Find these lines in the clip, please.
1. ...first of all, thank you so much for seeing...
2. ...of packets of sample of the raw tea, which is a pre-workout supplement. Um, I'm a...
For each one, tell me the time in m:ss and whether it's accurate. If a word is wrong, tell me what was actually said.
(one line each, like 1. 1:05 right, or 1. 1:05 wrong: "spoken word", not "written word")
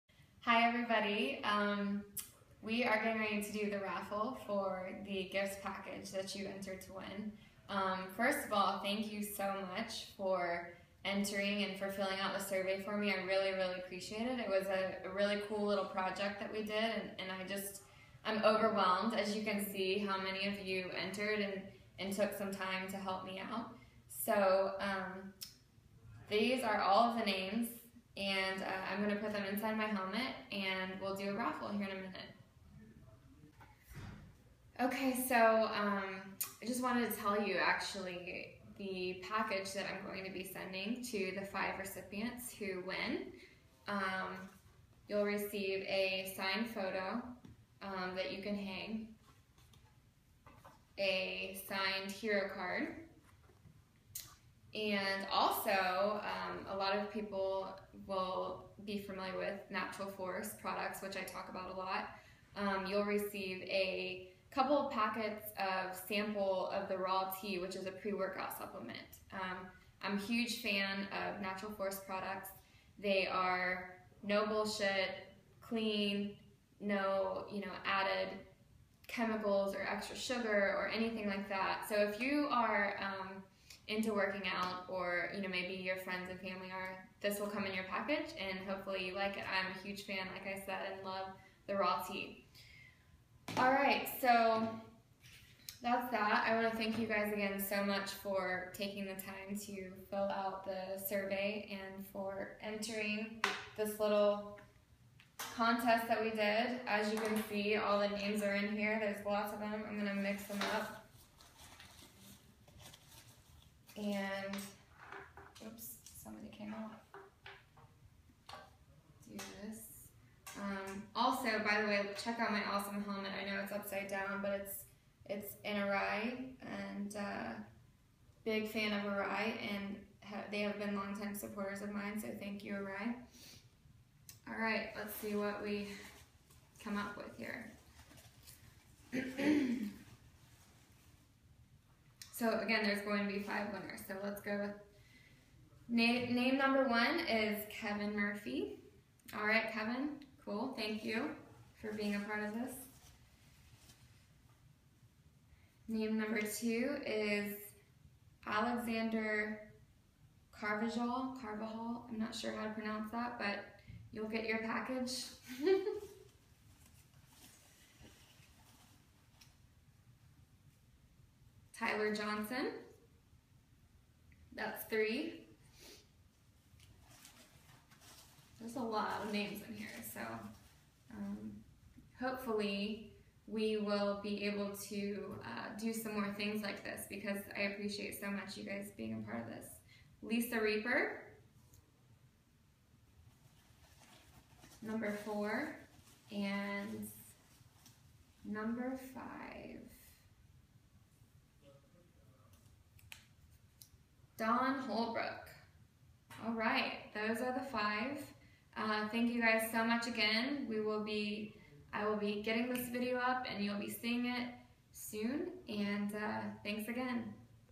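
1. 0:08 wrong: "entering", not "seeing"
2. 1:04 right.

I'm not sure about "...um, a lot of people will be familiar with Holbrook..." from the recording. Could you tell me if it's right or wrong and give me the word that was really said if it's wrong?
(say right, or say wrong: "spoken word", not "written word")
wrong: "Natural", not "Holbrook".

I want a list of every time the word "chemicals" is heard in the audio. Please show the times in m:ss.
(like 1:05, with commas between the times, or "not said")
1:19.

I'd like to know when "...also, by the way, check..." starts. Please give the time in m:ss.
2:01.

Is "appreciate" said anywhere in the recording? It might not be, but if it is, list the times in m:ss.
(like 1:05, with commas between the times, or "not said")
0:13, 3:07.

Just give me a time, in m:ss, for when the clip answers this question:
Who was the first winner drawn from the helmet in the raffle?
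2:27.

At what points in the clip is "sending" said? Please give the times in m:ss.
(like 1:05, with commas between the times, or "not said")
0:40.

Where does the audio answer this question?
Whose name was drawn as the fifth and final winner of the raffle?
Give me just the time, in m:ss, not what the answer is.
3:24.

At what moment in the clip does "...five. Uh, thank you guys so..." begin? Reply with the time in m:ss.
3:27.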